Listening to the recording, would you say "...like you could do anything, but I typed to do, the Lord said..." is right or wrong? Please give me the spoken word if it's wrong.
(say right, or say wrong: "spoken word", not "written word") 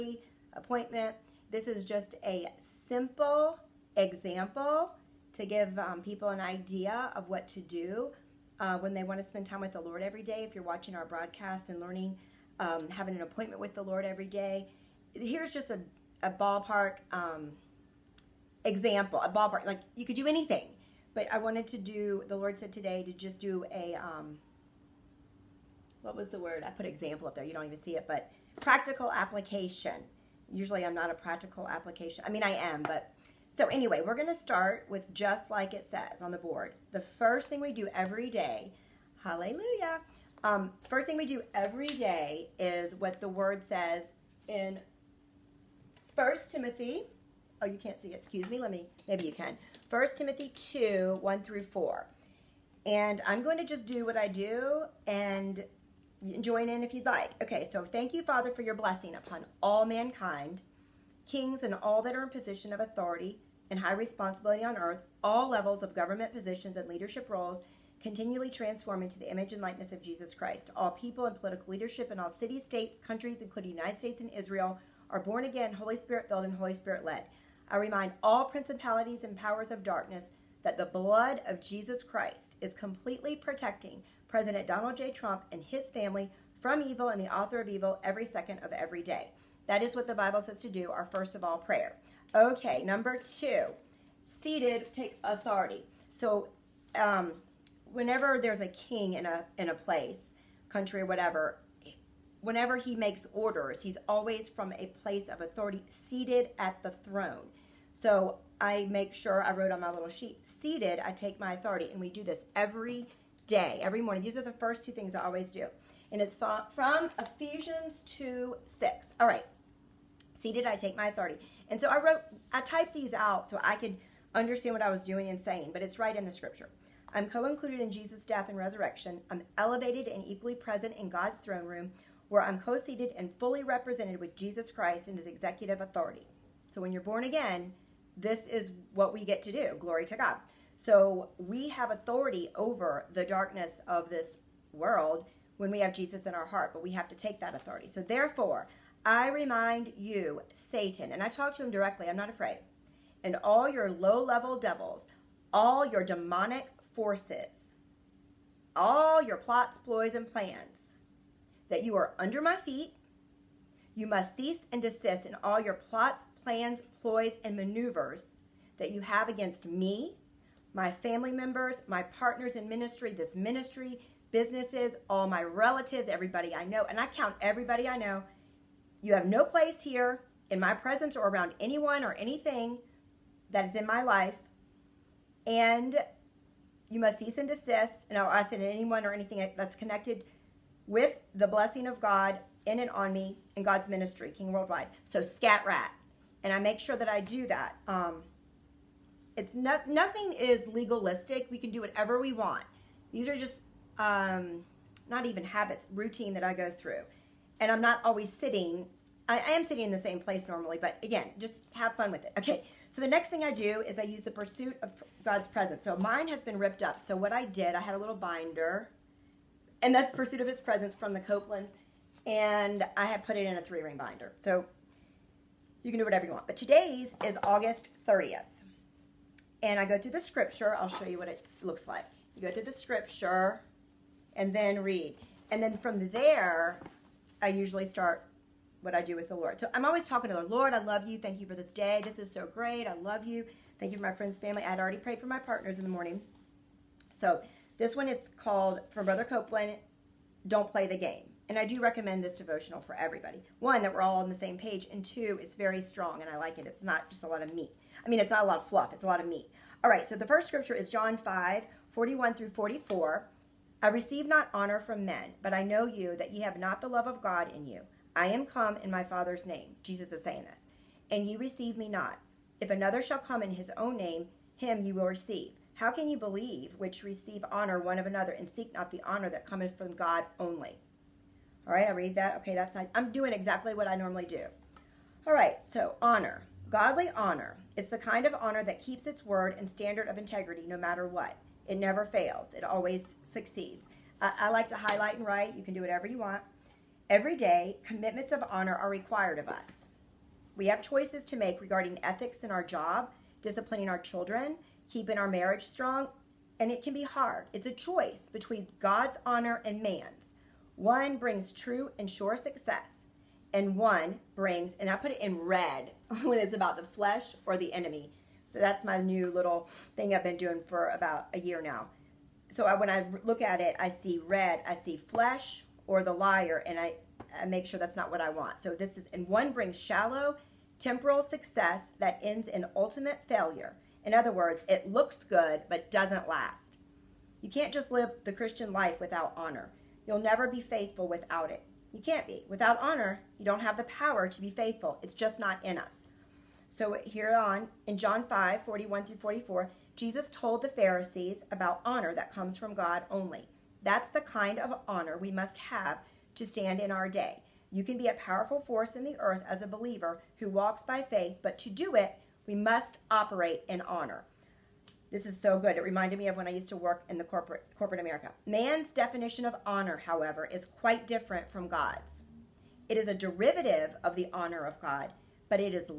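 wrong: "wanted", not "typed".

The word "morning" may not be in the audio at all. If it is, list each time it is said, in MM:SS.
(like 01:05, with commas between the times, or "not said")
01:54, 04:05.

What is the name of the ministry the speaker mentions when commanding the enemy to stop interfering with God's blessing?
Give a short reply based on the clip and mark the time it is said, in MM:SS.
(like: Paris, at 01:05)
King Worldwide, at 03:14.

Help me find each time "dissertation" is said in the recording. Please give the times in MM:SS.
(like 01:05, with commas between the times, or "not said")
not said.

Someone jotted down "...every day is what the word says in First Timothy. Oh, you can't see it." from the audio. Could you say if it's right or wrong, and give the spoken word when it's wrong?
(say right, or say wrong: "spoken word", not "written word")
right.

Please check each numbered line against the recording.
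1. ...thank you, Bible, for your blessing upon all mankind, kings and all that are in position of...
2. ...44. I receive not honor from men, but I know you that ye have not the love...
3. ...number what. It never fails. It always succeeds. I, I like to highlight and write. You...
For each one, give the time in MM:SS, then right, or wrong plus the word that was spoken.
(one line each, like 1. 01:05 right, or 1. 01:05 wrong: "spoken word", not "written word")
1. 00:57 wrong: "Father", not "Bible"
2. 04:22 right
3. 04:50 wrong: "matter", not "number".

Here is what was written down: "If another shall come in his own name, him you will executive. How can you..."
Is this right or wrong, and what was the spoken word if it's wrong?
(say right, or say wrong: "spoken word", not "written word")
wrong: "receive", not "executive".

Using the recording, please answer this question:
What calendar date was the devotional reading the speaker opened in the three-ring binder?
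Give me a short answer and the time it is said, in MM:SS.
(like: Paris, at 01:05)
August 30th, at 03:47.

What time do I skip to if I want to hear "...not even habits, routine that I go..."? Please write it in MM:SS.
03:25.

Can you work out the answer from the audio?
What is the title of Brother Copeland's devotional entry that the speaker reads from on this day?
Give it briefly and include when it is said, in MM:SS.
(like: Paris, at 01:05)
Don't Play the Game, at 04:10.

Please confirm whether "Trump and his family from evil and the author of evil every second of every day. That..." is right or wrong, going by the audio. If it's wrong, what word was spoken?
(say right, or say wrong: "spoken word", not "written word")
right.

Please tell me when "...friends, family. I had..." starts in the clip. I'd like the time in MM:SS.
04:04.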